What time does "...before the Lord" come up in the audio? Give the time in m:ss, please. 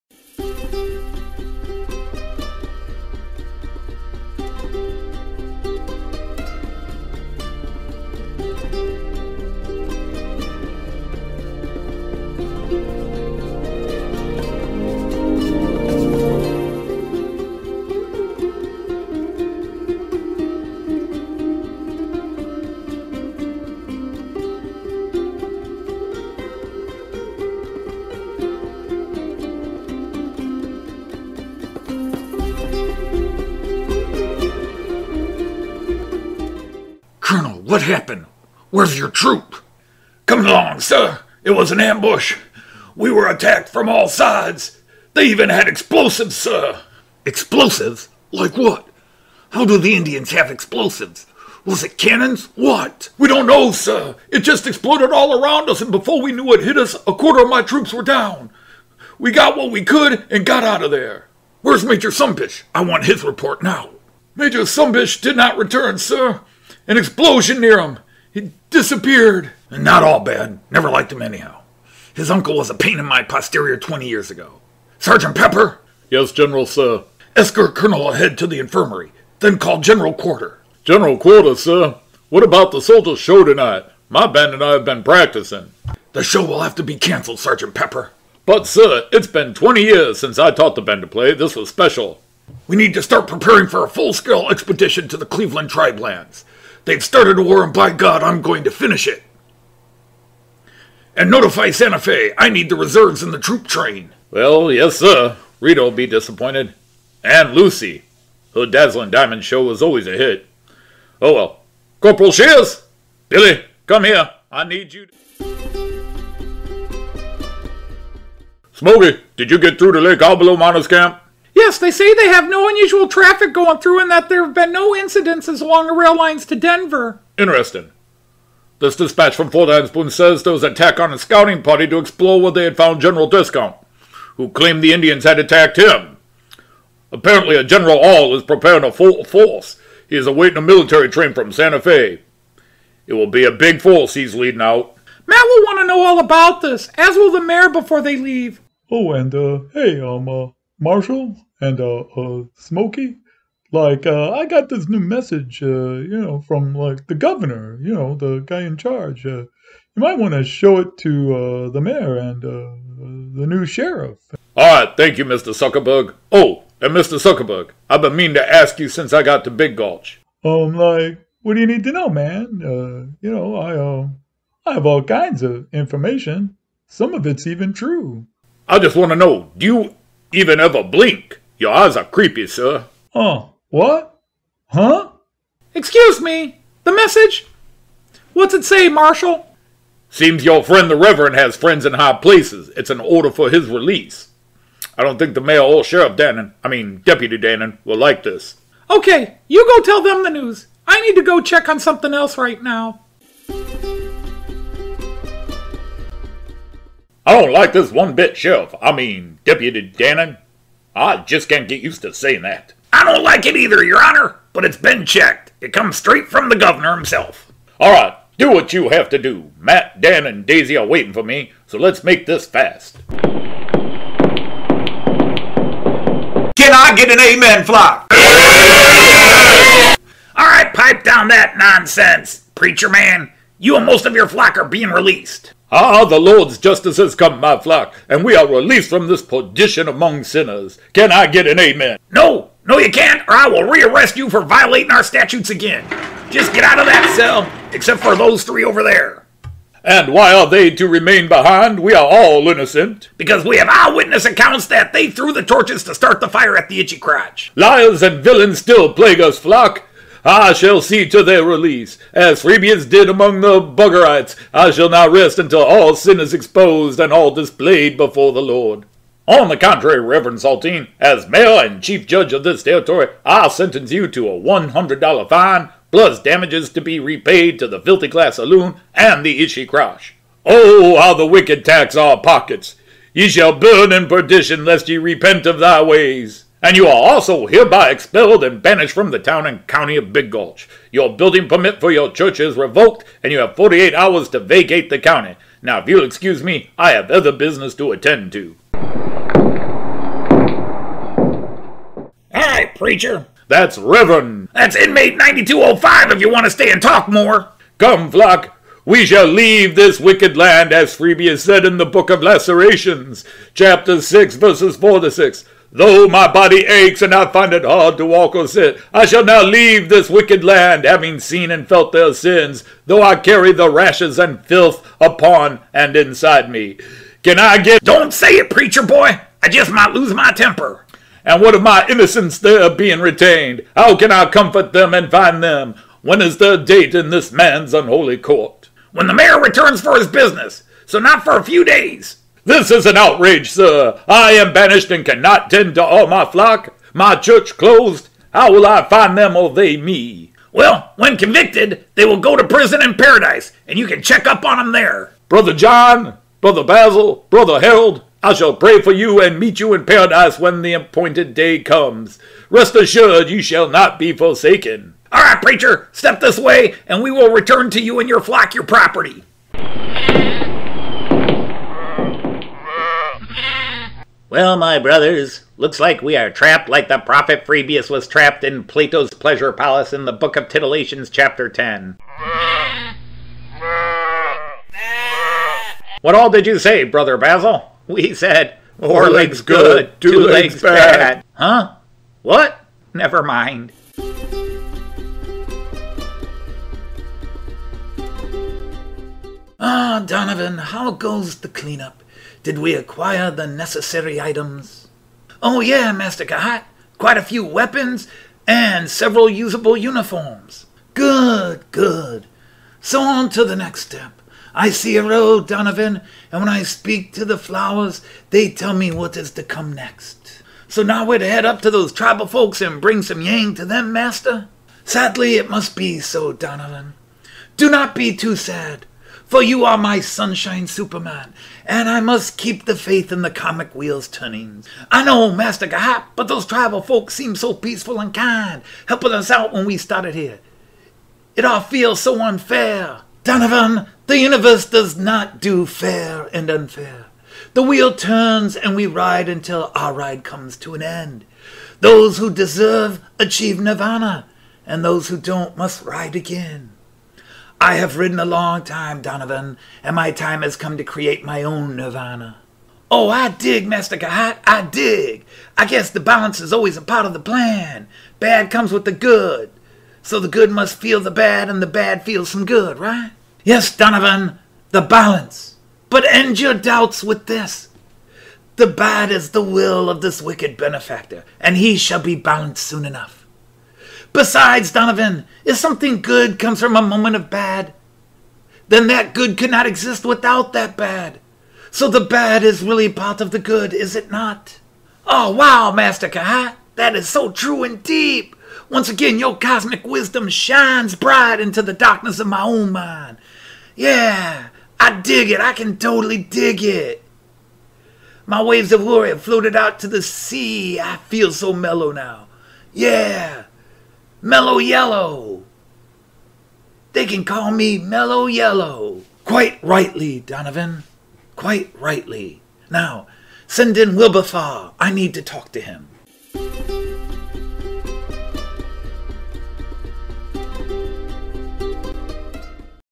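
4:27.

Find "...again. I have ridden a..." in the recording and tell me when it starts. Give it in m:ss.
7:36.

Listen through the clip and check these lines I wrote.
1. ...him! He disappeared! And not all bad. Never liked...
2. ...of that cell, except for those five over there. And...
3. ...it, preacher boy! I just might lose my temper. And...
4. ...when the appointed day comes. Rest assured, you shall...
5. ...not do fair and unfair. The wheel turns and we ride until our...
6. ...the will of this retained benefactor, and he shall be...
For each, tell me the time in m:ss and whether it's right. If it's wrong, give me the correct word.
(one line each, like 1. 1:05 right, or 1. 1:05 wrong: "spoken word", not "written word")
1. 1:07 right
2. 4:06 wrong: "three", not "five"
3. 5:28 right
4. 6:00 right
5. 7:24 right
6. 7:59 wrong: "wicked", not "retained".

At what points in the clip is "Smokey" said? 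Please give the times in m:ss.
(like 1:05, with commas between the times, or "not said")
1:58, 2:32.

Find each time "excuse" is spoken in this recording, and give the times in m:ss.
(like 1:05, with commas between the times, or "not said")
3:05, 4:56.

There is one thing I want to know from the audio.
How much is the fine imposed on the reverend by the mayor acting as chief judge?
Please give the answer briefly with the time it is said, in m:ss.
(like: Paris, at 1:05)
$100, at 4:34.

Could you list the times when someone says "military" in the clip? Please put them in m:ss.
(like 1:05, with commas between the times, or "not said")
2:20.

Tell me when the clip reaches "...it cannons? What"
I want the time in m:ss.
0:51.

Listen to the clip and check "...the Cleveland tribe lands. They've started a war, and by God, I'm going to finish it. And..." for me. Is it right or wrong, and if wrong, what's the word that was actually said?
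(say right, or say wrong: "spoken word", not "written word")
right.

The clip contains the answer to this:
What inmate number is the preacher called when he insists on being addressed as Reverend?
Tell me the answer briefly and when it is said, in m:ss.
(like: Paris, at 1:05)
9205, at 5:04.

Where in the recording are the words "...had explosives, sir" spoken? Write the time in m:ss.
0:45.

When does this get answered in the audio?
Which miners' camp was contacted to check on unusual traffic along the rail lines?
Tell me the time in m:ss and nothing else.
2:00.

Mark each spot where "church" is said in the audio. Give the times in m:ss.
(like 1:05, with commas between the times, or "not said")
4:52, 5:47.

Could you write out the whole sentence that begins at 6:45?
Oh yeah, Master K'hat, quite a few weapons and several usable uniforms.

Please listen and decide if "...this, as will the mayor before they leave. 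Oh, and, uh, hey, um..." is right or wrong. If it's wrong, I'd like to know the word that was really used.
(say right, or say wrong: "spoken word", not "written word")
right.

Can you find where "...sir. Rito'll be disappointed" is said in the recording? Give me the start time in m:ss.
1:44.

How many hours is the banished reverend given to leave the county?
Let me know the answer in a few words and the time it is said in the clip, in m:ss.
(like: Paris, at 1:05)
48, at 4:53.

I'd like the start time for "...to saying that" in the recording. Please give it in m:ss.
3:32.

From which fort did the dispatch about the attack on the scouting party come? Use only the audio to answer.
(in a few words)
Fort Anspoon.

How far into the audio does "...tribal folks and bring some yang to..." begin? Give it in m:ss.
7:01.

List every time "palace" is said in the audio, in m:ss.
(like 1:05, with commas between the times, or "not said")
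6:19.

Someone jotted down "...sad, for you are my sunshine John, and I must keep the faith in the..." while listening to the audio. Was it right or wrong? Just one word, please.
wrong.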